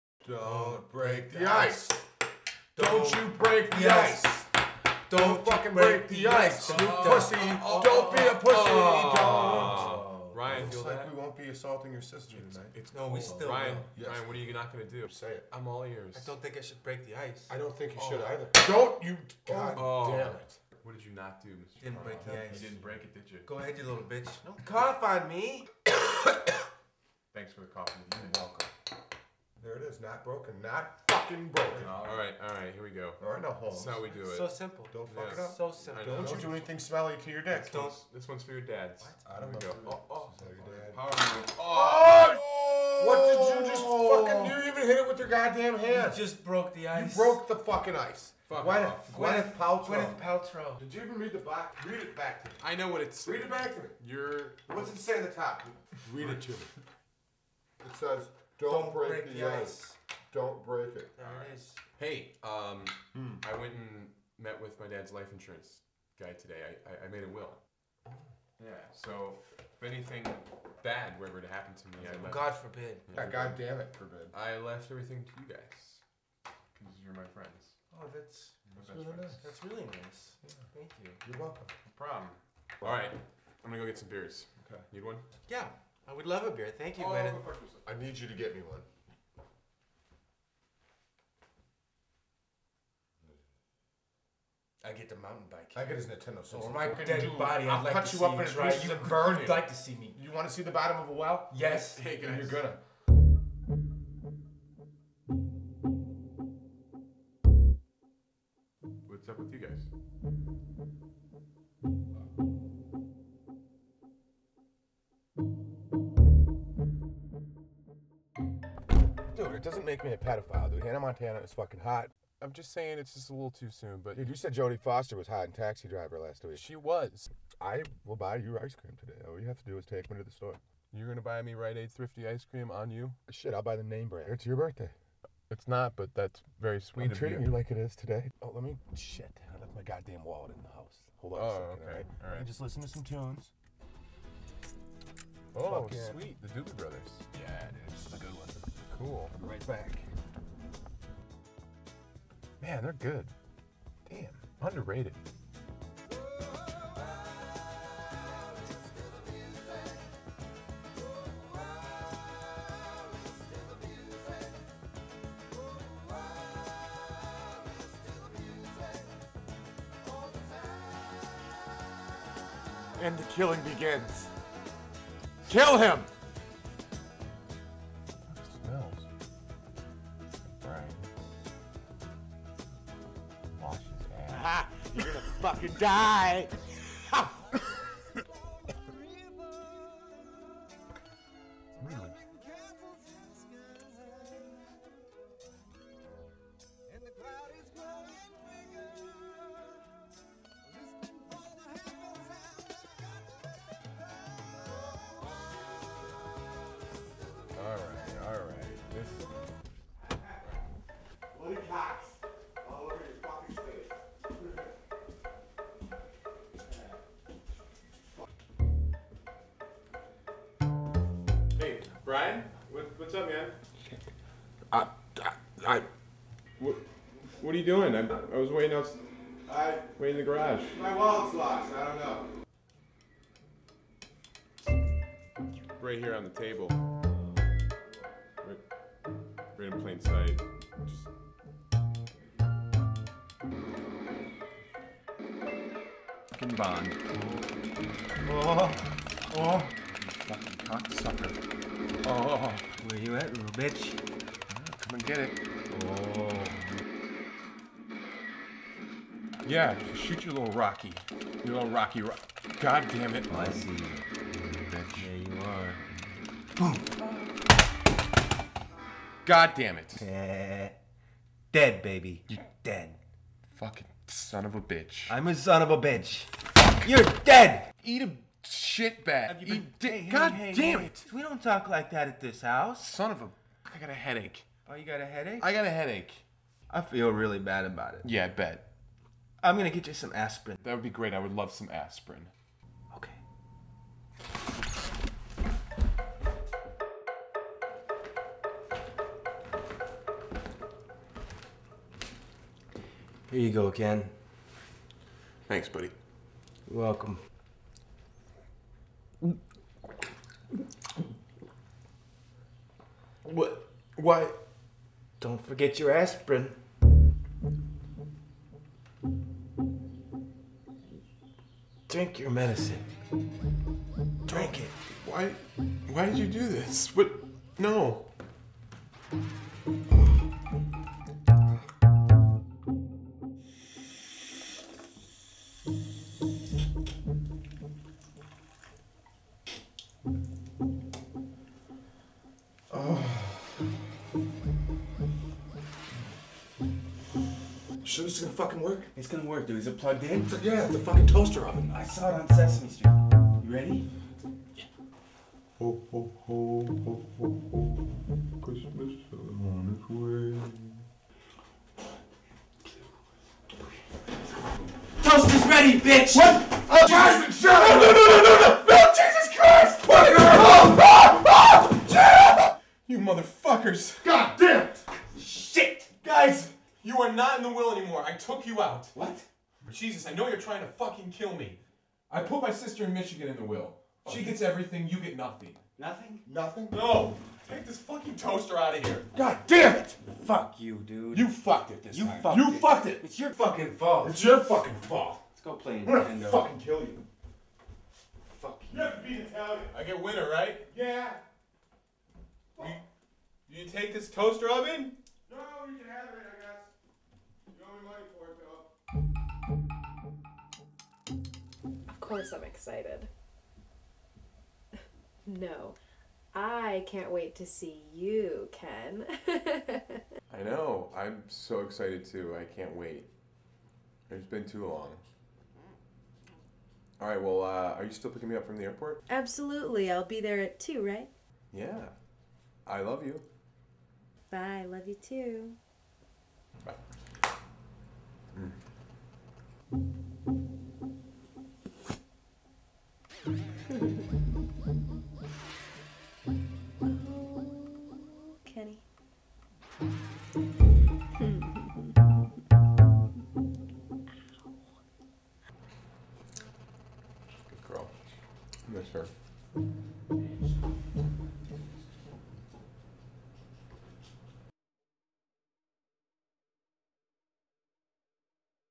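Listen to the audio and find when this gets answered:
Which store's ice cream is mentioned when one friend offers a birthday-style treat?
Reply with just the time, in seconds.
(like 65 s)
131 s.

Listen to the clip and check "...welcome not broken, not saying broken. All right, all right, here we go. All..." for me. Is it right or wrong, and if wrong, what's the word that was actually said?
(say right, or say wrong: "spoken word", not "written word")
wrong: "fucking", not "saying".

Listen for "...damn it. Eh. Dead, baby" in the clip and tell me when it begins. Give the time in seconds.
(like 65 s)
269 s.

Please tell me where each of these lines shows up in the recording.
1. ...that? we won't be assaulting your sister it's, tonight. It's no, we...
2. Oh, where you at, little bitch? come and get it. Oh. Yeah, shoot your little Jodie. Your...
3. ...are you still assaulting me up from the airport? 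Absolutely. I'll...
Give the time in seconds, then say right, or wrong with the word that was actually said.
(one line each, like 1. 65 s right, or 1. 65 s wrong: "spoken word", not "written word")
1. 10 s right
2. 252 s wrong: "Rocky", not "Jodie"
3. 427 s wrong: "picking", not "assaulting".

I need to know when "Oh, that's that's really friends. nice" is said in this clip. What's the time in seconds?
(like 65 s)
77 s.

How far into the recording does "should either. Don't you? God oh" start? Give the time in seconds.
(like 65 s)
18 s.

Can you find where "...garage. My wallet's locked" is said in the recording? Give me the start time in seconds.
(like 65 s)
230 s.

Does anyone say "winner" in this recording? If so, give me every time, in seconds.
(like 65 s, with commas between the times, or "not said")
400 s.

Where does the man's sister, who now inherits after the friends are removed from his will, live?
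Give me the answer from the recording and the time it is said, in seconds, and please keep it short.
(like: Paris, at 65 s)
Michigan, at 382 s.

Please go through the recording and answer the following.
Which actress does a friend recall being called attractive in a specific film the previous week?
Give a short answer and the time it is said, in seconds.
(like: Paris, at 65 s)
Jodie Foster, at 124 s.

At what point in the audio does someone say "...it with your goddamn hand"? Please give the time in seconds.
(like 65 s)
45 s.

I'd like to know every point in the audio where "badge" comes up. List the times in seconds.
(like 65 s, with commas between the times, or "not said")
not said.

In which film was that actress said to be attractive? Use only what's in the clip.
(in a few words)
Taxi Driver.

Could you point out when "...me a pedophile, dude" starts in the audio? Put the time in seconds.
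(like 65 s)
120 s.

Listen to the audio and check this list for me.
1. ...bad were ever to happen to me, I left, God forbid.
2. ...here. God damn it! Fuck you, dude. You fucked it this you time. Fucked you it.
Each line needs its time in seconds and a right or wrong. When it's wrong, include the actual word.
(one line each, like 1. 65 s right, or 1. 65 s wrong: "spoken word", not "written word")
1. 70 s right
2. 388 s right.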